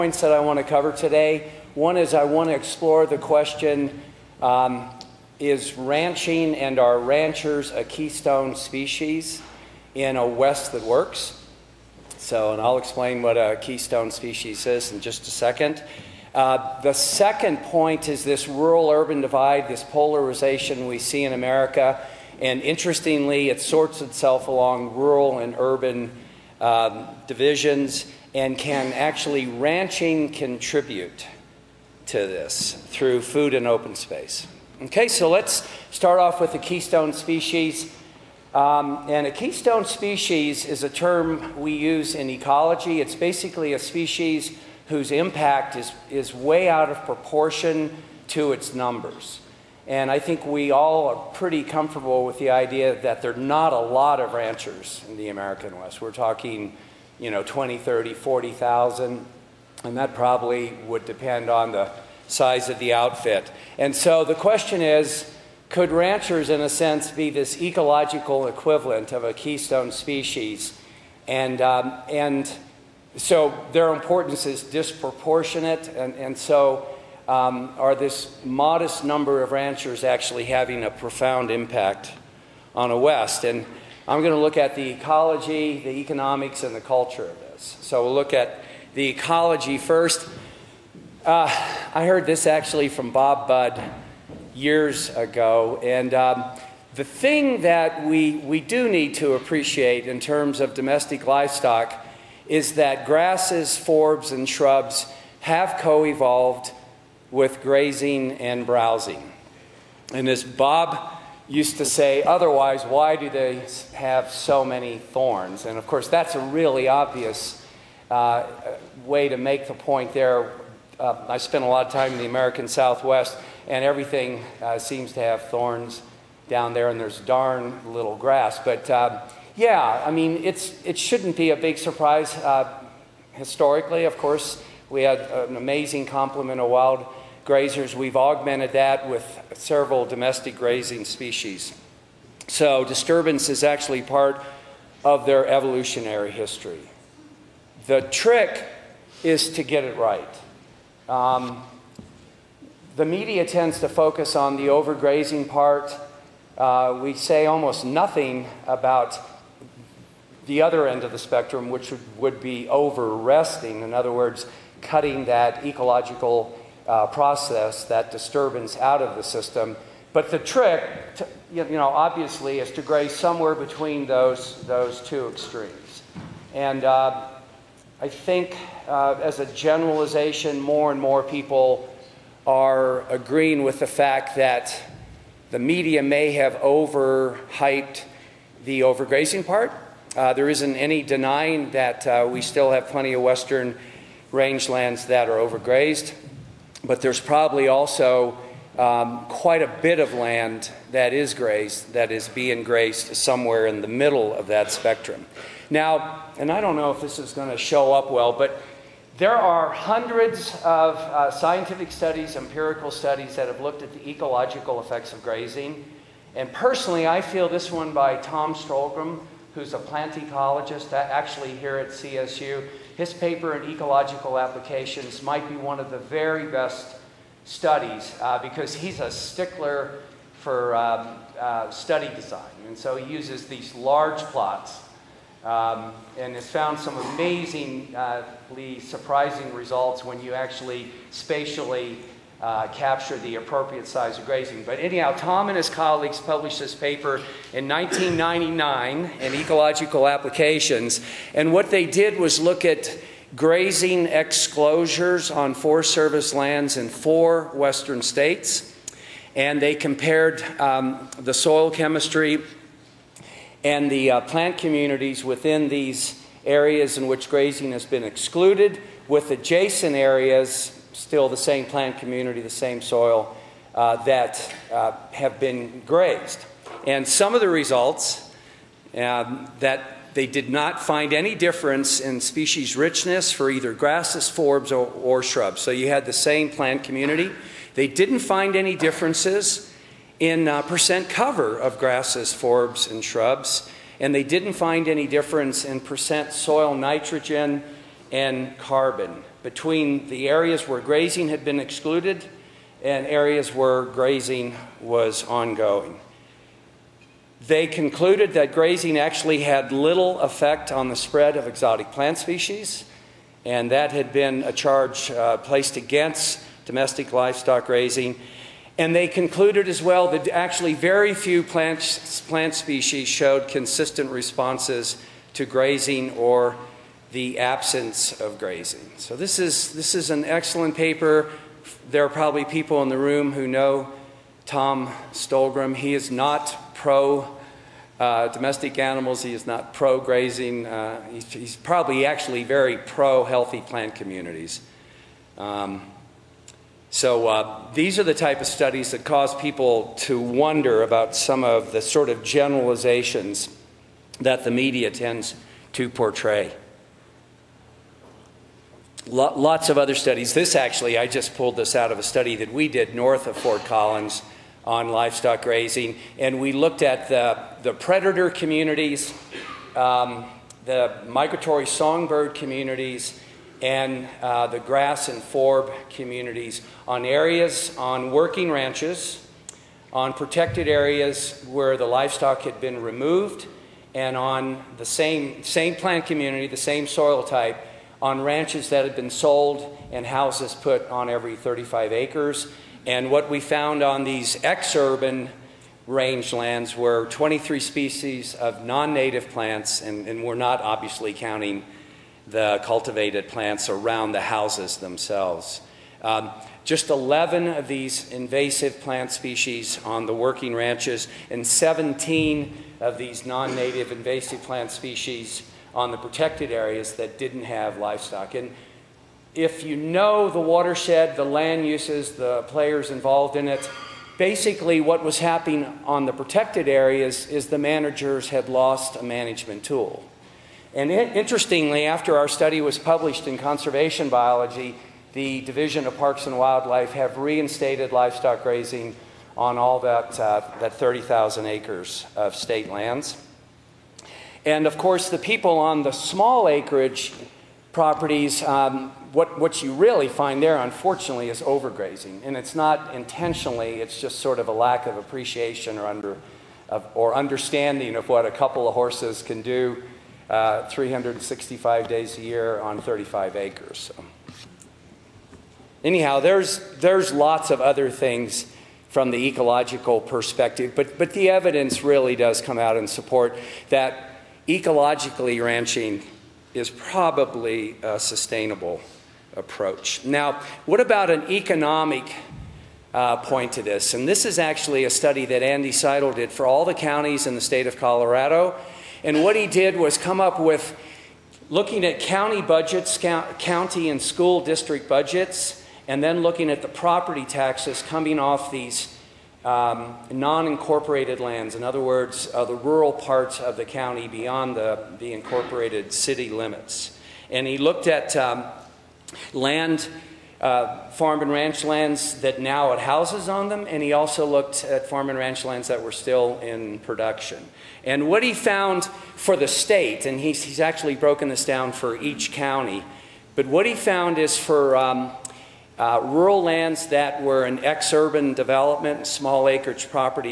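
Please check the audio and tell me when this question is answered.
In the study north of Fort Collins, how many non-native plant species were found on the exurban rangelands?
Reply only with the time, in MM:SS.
06:37.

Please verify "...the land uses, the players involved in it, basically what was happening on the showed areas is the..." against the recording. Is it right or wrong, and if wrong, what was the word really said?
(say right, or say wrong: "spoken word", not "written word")
wrong: "protected", not "showed".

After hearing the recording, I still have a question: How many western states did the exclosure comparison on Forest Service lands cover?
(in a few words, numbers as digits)
Four.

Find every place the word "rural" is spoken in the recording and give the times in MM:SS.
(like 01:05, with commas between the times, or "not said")
00:18, 00:24, 08:22, 08:46.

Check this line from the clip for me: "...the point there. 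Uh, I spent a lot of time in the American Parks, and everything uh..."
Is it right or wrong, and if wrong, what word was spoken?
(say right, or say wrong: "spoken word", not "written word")
wrong: "Southwest", not "Parks".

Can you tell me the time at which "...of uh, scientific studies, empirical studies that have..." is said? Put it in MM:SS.
03:30.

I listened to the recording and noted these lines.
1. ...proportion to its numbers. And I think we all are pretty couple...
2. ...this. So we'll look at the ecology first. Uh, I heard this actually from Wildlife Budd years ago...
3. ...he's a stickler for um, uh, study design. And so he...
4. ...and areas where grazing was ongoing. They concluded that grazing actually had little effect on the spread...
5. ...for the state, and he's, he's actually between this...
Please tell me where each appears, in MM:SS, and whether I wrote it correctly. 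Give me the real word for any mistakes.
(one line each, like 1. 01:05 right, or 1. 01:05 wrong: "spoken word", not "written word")
1. 00:47 wrong: "comfortable", not "couple"
2. 01:27 wrong: "Bob", not "Wildlife"
3. 03:48 right
4. 05:02 right
5. 08:39 wrong: "broken", not "between".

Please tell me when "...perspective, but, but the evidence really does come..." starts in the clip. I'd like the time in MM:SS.
07:49.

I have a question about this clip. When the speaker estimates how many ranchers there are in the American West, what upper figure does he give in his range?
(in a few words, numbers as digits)
40,000.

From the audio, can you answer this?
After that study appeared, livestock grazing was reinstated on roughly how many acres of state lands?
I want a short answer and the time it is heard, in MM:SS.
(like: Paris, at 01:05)
30,000 acres, at 07:20.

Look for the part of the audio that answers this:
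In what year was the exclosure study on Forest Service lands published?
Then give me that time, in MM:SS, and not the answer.
04:07.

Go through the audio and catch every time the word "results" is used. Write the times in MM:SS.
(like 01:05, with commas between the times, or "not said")
03:59, 04:37.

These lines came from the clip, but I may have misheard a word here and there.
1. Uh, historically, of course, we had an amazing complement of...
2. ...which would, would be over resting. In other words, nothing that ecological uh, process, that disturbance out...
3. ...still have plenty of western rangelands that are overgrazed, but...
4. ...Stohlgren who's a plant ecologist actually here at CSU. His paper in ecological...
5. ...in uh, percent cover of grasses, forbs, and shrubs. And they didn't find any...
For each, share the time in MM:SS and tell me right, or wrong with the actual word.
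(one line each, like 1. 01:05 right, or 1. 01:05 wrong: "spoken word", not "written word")
1. 02:12 right
2. 02:41 wrong: "cutting", not "nothing"
3. 03:12 right
4. 03:38 right
5. 04:50 right.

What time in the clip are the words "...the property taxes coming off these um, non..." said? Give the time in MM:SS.
08:16.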